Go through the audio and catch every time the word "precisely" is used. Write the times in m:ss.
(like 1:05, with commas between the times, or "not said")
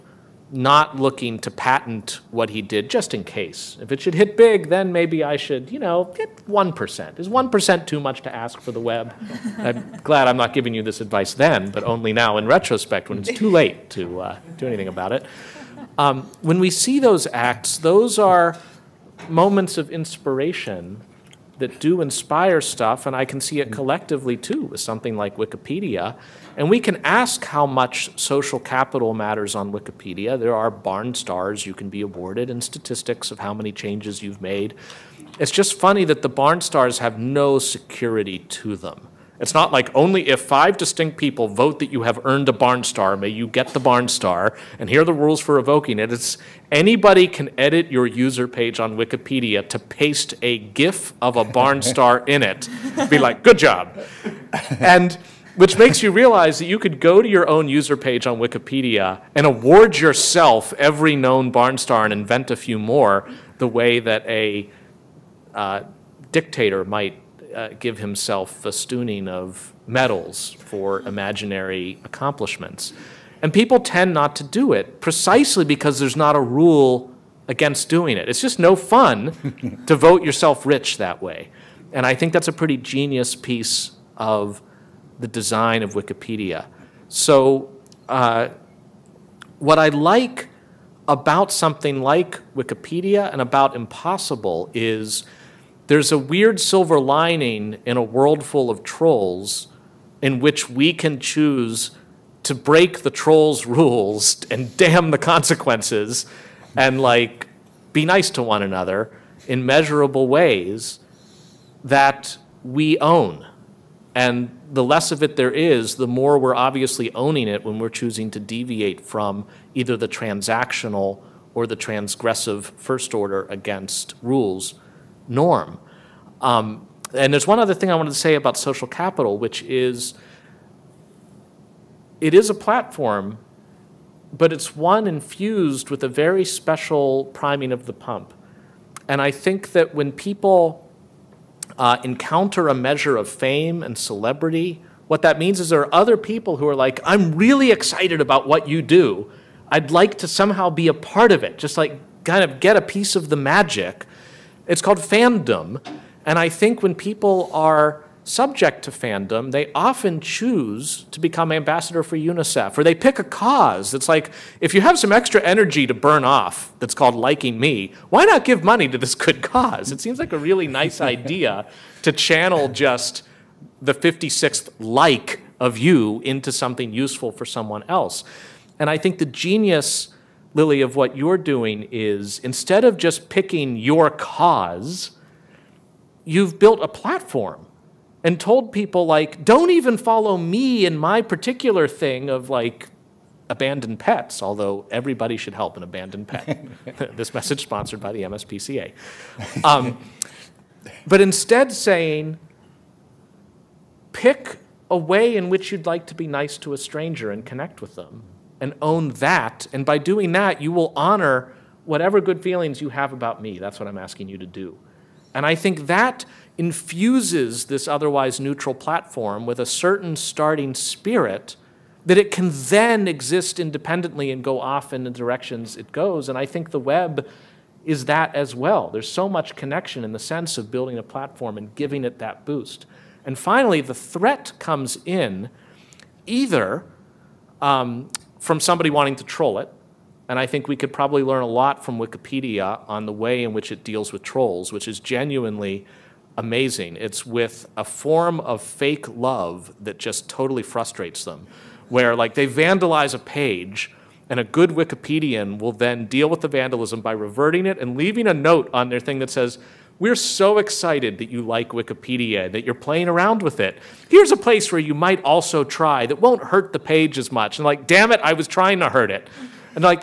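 1:15.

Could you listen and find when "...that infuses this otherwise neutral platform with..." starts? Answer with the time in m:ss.
3:35.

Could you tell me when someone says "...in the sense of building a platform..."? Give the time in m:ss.
3:50.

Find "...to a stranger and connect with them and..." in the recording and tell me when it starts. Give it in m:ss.
3:26.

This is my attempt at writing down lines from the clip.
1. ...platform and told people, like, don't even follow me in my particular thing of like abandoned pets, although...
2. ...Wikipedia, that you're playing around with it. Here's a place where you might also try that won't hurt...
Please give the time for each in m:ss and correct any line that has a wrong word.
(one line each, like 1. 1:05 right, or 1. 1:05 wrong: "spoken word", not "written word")
1. 3:06 right
2. 4:21 right.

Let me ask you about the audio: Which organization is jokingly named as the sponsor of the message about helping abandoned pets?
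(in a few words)
MSPCA.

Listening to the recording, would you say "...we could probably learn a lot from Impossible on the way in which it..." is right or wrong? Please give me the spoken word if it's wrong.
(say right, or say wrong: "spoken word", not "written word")
wrong: "Wikipedia", not "Impossible".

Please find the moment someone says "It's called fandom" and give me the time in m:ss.
2:34.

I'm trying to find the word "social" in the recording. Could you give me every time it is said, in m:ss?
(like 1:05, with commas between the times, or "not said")
0:28, 2:08.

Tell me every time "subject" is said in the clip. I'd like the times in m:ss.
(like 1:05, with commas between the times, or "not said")
2:38.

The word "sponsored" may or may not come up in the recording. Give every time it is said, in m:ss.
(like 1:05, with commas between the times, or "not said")
3:17.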